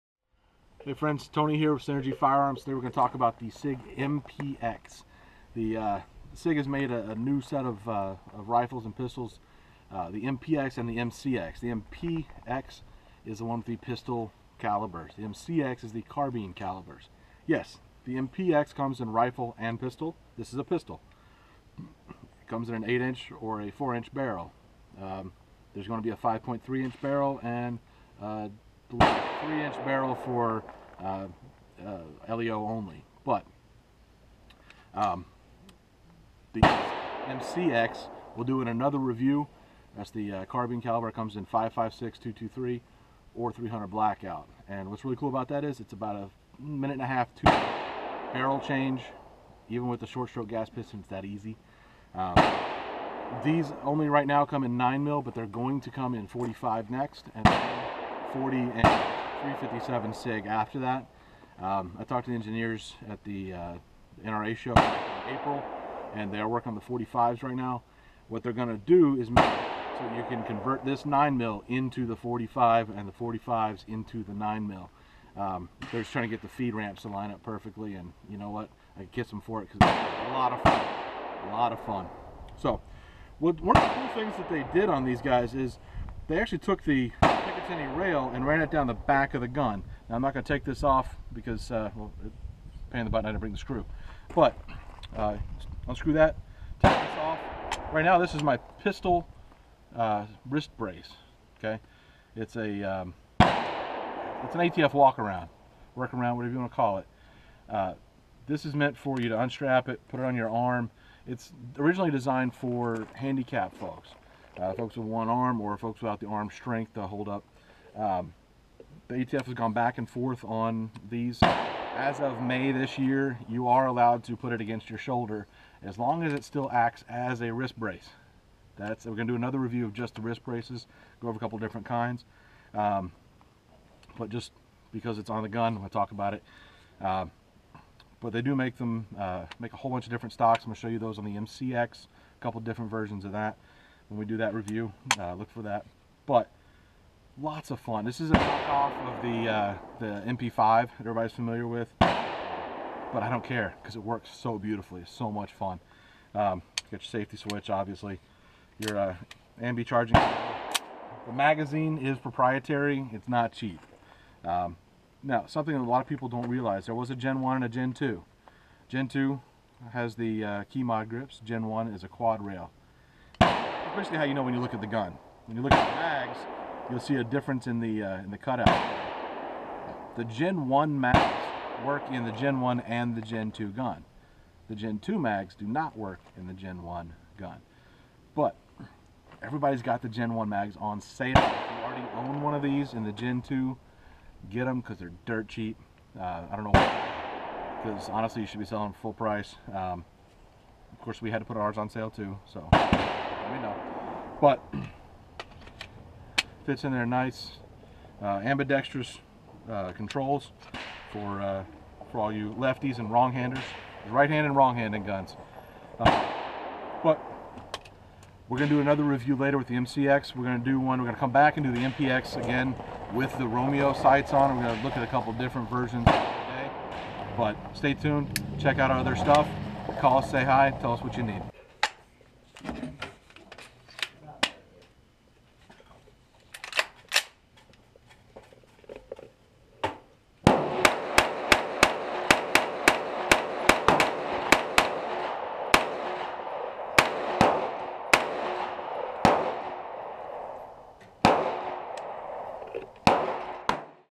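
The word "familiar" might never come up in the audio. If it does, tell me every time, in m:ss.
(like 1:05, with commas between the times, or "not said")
2:31.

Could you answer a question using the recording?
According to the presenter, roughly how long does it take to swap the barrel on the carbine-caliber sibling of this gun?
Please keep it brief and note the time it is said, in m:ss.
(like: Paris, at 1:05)
a minute and a half, at 0:45.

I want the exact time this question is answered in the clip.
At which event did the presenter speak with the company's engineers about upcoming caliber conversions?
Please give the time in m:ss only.
1:04.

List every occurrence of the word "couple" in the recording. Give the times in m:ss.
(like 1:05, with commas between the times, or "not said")
2:11, 2:22, 3:45.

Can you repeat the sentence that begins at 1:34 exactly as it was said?
But uh, unscrew that, take this off.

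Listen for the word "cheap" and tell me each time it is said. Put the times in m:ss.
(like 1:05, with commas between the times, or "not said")
2:43, 3:15.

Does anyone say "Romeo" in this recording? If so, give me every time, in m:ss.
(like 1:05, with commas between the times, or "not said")
3:43.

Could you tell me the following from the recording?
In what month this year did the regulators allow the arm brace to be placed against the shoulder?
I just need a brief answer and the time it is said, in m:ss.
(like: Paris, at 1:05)
May, at 2:02.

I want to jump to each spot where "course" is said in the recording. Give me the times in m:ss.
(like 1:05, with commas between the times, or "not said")
3:21.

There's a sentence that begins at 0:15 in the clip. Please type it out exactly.
The MCX is the carbine calibers.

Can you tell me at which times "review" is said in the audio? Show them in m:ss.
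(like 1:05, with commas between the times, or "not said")
0:38, 2:09, 2:24, 3:39.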